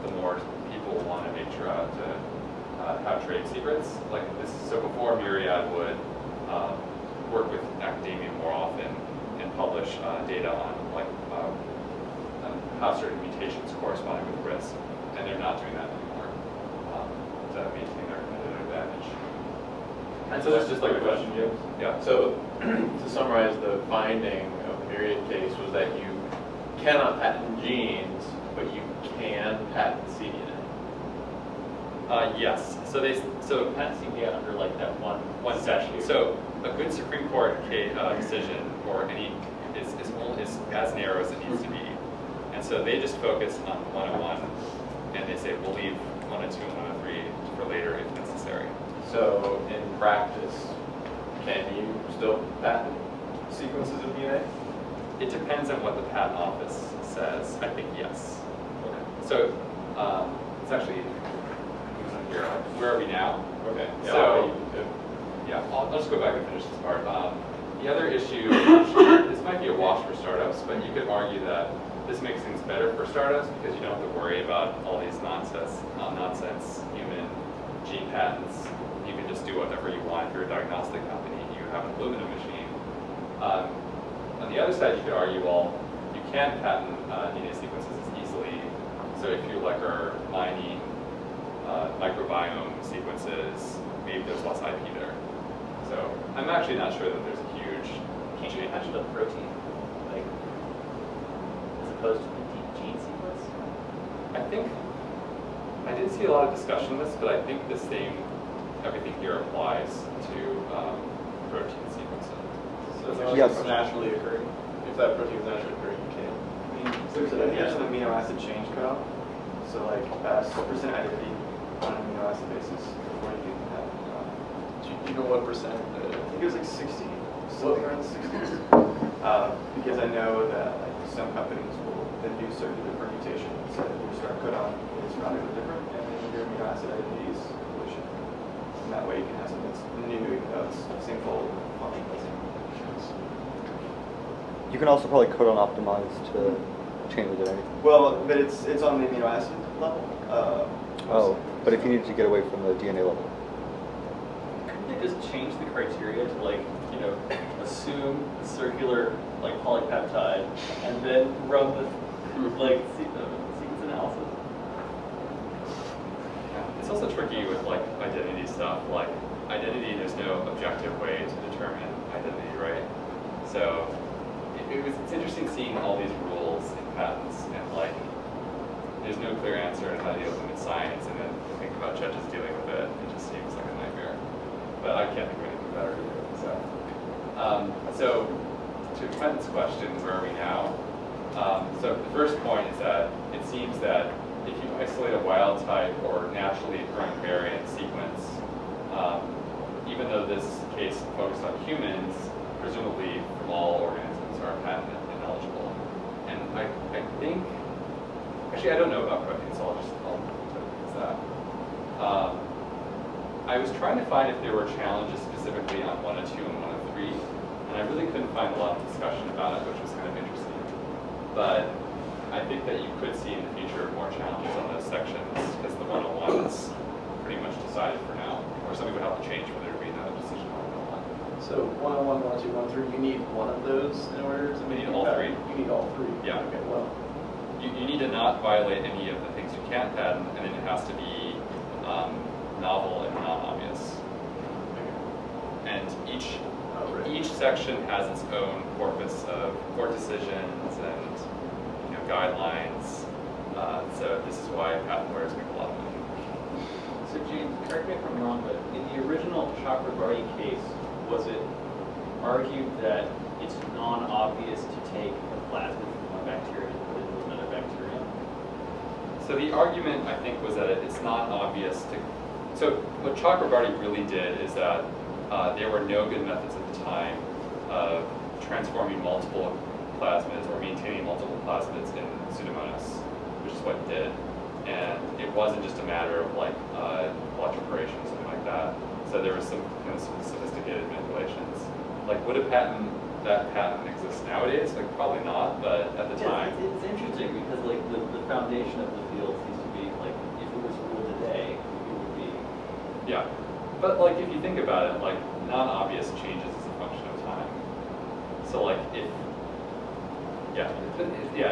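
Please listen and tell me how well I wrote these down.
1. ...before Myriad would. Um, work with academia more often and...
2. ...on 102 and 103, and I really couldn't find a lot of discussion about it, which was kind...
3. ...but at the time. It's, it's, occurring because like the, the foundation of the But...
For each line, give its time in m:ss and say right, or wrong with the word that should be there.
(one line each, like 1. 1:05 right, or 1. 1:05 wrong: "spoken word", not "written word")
1. 0:04 right
2. 3:35 right
3. 4:55 wrong: "interesting", not "occurring".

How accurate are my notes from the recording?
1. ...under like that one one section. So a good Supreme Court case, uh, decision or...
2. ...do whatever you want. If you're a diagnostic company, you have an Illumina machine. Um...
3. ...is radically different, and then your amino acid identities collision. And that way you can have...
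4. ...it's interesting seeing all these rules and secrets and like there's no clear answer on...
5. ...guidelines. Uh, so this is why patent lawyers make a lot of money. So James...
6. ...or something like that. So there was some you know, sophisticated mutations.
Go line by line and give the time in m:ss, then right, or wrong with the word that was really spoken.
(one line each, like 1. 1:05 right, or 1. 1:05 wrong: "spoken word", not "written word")
1. 0:34 right
2. 1:19 right
3. 2:15 right
4. 2:55 wrong: "patents", not "secrets"
5. 4:12 right
6. 4:47 wrong: "manipulations", not "mutations".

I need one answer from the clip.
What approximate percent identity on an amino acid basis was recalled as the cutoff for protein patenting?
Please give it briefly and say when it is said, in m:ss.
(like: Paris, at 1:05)
60, at 2:07.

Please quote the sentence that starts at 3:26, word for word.
And I, I think, actually I don't know about protein so I'll just, I'll, that.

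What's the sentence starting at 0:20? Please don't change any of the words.
And so that's just like a question, James.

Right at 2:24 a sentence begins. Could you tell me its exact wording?
You can also probably codon optimize to change the identity.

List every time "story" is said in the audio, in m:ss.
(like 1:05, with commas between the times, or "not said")
not said.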